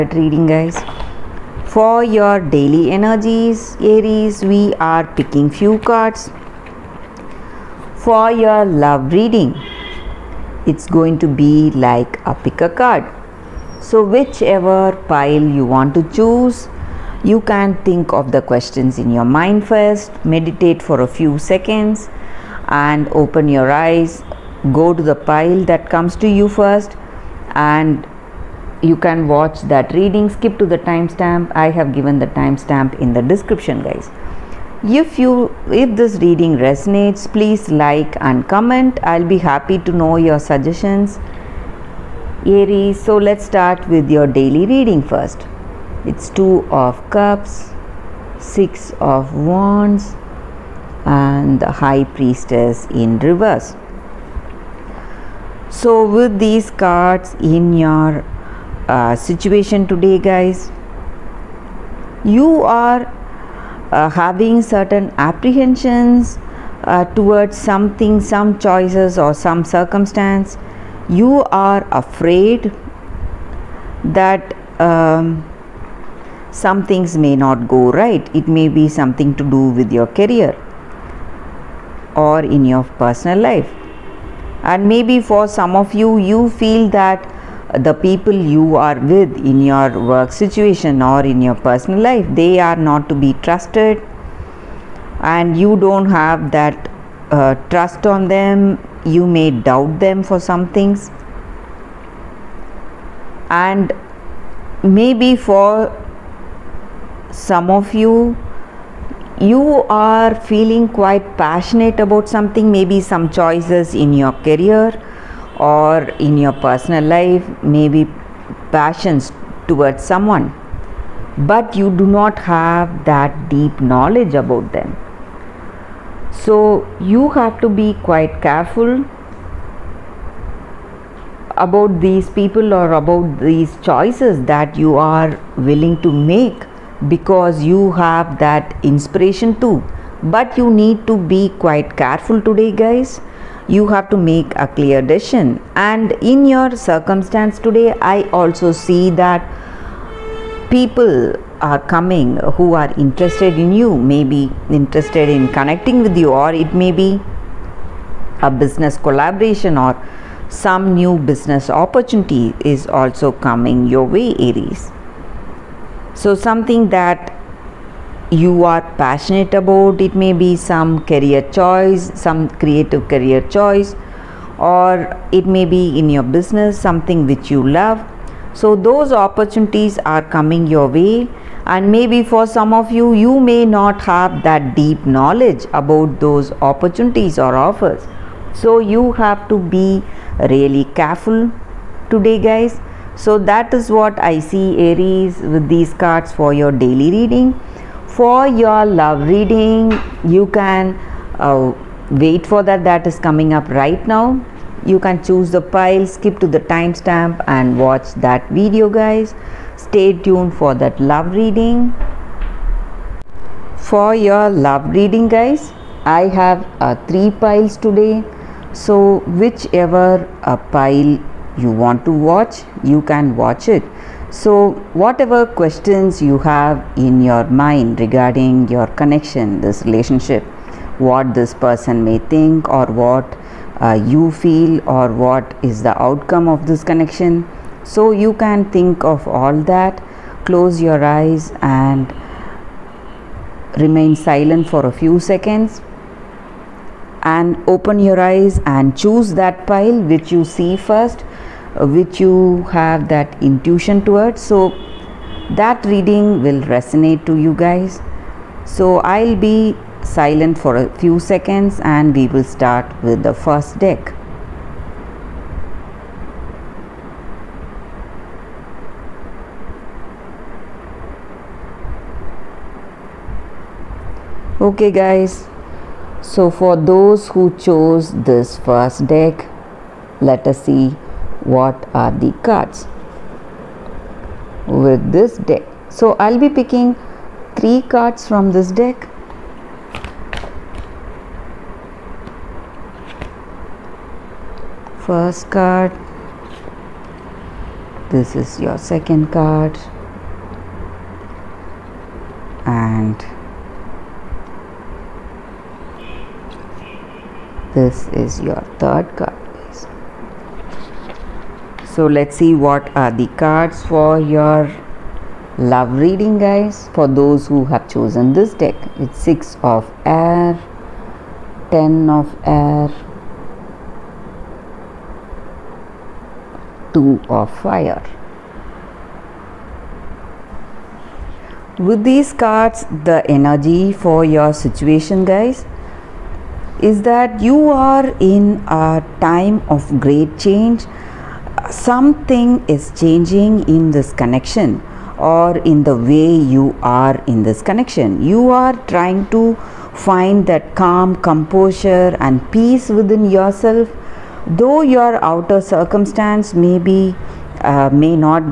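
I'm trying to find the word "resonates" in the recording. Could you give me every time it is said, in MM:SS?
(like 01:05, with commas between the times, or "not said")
00:36, 04:16.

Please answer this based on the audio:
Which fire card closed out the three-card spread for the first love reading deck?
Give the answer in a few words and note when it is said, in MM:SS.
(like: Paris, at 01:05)
Two of fire, at 05:26.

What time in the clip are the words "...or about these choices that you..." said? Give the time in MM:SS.
02:12.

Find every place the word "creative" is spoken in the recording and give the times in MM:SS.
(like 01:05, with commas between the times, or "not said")
02:52.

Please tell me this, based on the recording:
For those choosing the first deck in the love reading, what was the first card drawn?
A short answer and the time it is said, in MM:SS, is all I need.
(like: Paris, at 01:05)
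Six of air, at 05:19.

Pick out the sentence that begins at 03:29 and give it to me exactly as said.
Stay tuned for that love reading.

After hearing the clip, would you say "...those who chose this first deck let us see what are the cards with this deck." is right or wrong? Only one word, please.
right.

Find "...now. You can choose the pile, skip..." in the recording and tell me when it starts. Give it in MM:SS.
03:24.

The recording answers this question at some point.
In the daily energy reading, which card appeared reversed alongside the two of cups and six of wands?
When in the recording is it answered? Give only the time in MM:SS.
00:51.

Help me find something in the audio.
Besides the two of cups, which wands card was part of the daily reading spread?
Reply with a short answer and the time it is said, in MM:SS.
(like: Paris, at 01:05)
6 of wands, at 00:48.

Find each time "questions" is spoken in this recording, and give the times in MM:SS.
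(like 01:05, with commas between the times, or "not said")
00:18, 03:45.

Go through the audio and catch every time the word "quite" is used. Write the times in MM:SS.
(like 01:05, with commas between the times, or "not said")
01:50, 02:08, 02:21.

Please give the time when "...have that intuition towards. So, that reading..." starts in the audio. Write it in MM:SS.
04:12.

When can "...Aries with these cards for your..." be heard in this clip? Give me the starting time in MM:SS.
03:14.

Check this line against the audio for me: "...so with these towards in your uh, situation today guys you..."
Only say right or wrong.
wrong.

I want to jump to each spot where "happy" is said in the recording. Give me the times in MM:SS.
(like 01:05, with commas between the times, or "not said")
00:39.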